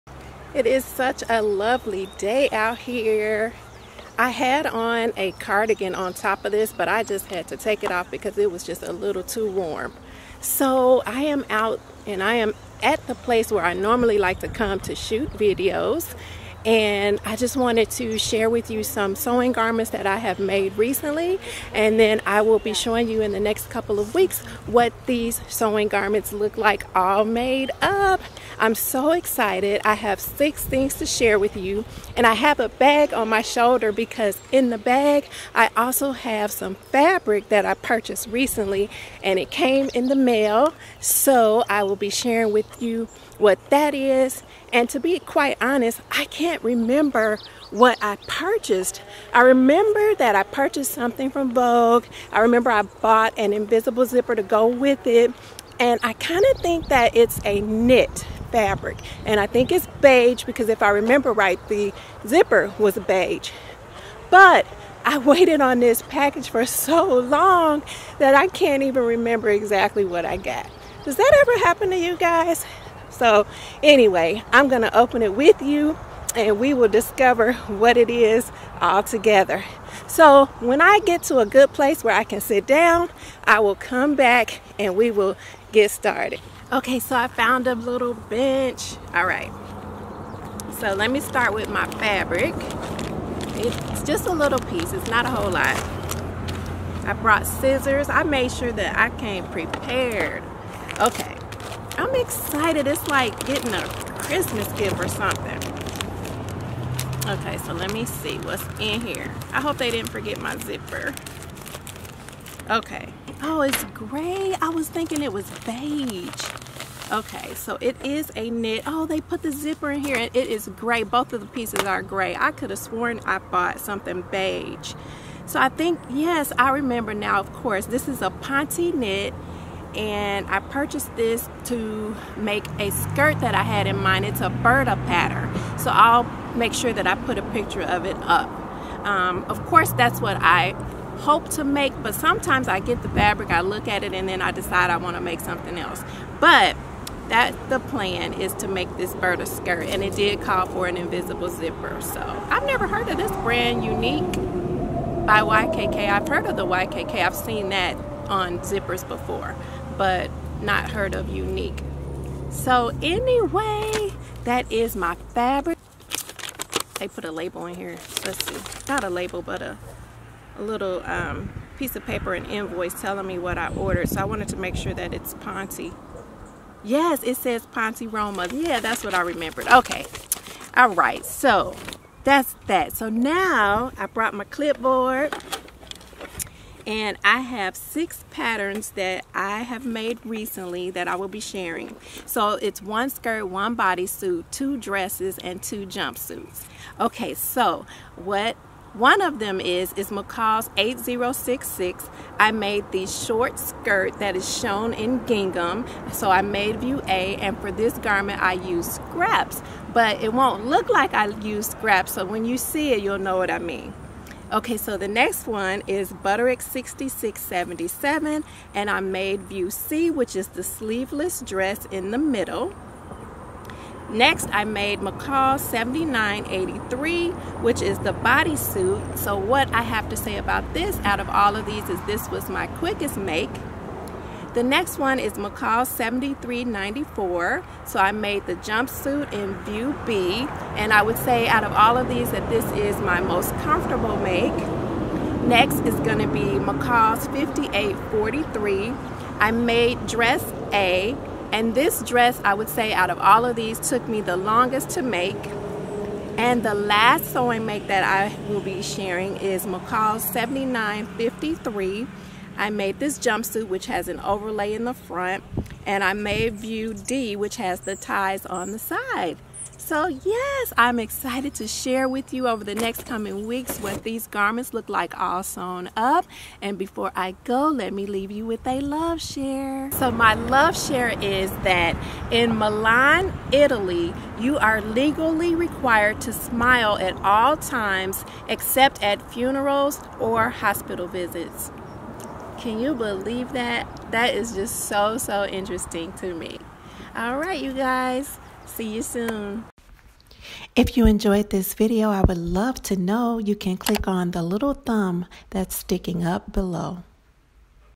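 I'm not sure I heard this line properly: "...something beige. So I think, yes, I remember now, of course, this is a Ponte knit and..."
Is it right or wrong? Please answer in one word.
right.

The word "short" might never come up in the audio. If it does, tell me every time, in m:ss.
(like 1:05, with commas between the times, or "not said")
3:23.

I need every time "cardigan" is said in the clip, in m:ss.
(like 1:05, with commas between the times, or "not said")
0:05.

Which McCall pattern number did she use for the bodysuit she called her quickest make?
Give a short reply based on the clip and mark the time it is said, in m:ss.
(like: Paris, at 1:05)
McCall 7983, at 3:44.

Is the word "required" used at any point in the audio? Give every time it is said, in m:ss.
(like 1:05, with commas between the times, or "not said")
4:45.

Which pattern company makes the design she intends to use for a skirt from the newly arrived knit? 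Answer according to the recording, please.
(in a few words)
Burda.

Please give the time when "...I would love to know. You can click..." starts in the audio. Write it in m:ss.
5:02.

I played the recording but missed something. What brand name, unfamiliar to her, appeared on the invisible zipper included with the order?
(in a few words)
Unique by YKK.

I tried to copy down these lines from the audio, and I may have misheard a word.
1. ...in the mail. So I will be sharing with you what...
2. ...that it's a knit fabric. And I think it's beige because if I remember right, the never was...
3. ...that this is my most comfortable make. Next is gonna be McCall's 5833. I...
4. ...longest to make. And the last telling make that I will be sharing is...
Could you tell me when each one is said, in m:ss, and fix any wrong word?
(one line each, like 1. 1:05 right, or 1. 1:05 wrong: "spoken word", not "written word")
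1. 0:39 right
2. 0:56 wrong: "zipper", not "never"
3. 4:02 wrong: "5843", not "5833"
4. 4:14 wrong: "sewing", not "telling".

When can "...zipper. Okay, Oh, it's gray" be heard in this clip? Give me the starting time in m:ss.
1:50.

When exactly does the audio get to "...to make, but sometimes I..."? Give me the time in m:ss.
2:21.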